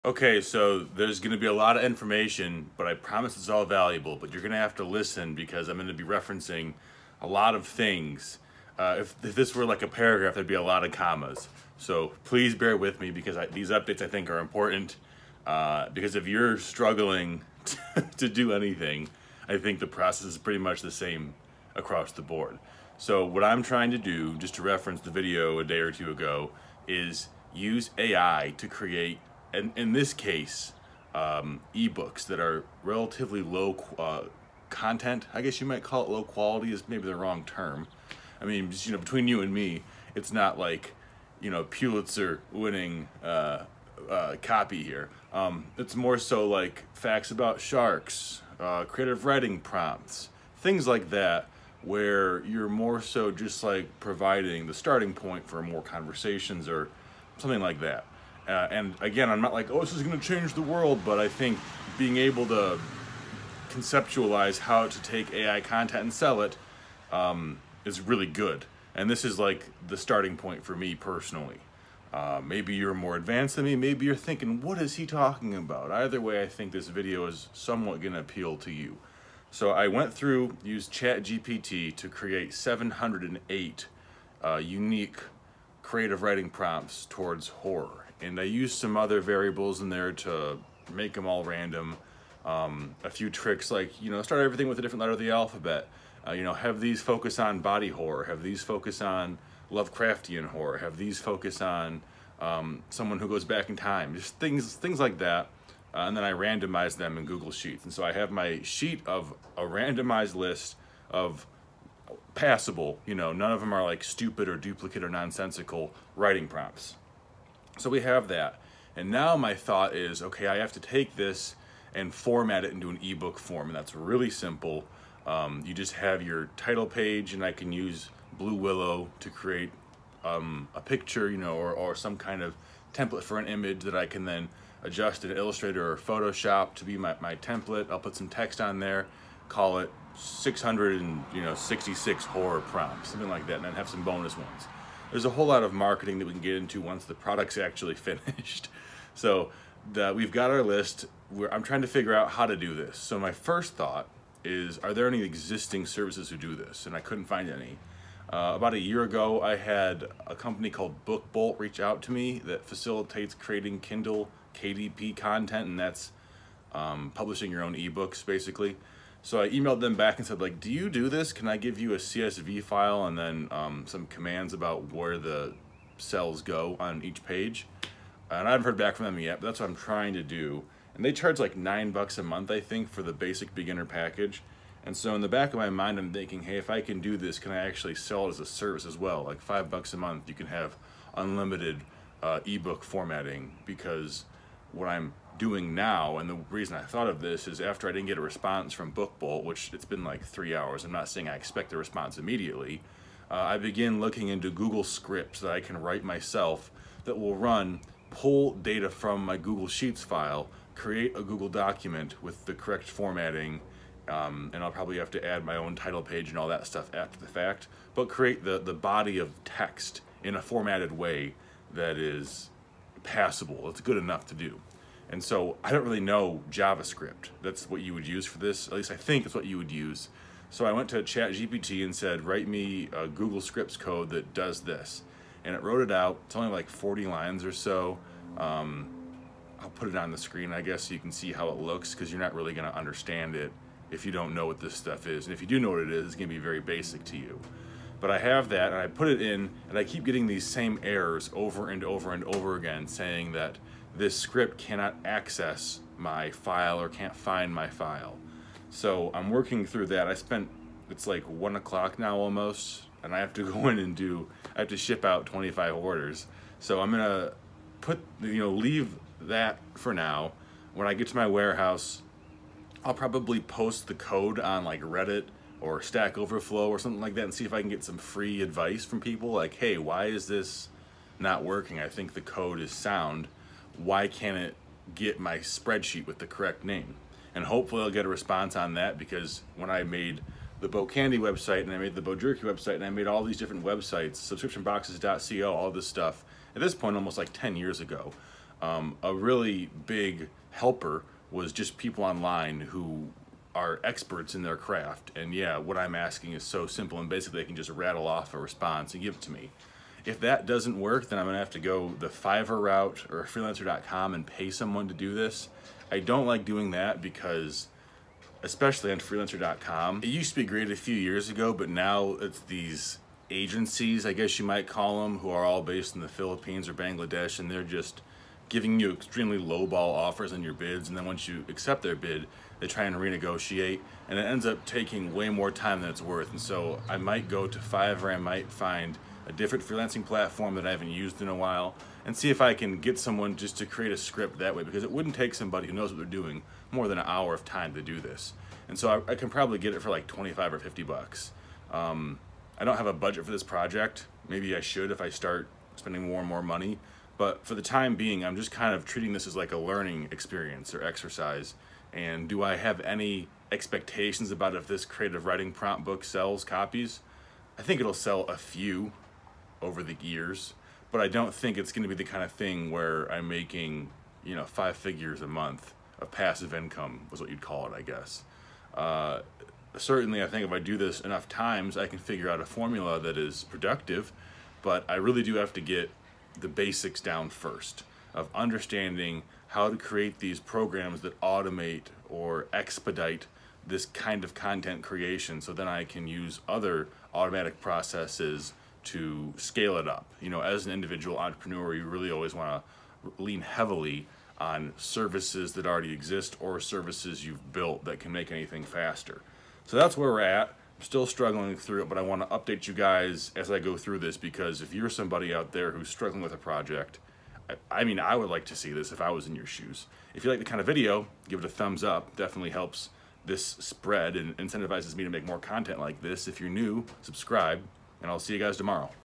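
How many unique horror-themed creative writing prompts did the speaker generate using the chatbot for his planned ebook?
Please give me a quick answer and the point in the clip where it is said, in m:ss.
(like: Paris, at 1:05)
708, at 1:22.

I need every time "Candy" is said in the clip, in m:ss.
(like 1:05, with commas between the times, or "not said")
4:50.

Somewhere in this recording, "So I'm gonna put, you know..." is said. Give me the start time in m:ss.
4:26.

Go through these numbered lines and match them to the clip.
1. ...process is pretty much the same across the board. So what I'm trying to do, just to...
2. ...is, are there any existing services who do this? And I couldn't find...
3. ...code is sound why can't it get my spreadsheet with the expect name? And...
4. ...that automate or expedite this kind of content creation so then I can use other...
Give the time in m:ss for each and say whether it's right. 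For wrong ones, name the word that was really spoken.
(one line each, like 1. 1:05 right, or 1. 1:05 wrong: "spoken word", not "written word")
1. 0:19 right
2. 2:34 right
3. 4:42 wrong: "correct", not "expect"
4. 6:31 right.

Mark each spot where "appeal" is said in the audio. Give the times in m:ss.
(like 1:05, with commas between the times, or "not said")
1:18.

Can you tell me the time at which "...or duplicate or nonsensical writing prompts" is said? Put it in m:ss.
1:54.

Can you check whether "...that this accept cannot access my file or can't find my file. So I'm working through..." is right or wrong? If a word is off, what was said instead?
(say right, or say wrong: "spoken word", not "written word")
wrong: "script", not "accept".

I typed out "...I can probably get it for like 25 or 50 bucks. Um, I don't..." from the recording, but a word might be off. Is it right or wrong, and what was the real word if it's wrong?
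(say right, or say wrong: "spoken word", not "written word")
right.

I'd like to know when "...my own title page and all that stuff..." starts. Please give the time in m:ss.
3:35.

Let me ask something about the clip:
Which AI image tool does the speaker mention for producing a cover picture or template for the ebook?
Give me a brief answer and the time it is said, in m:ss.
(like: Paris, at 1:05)
Blue Willow, at 2:08.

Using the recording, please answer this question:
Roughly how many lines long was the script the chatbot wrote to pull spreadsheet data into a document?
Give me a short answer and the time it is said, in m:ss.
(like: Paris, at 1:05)
40, at 3:56.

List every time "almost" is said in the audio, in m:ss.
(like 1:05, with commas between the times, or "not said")
4:22, 4:56.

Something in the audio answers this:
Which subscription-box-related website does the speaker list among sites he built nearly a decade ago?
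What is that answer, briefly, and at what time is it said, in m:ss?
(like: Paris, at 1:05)
subscriptionboxes.co, at 4:54.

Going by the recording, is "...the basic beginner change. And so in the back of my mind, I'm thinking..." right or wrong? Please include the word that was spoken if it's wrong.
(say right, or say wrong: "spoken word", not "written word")
wrong: "package", not "change".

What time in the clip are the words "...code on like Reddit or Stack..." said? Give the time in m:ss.
4:33.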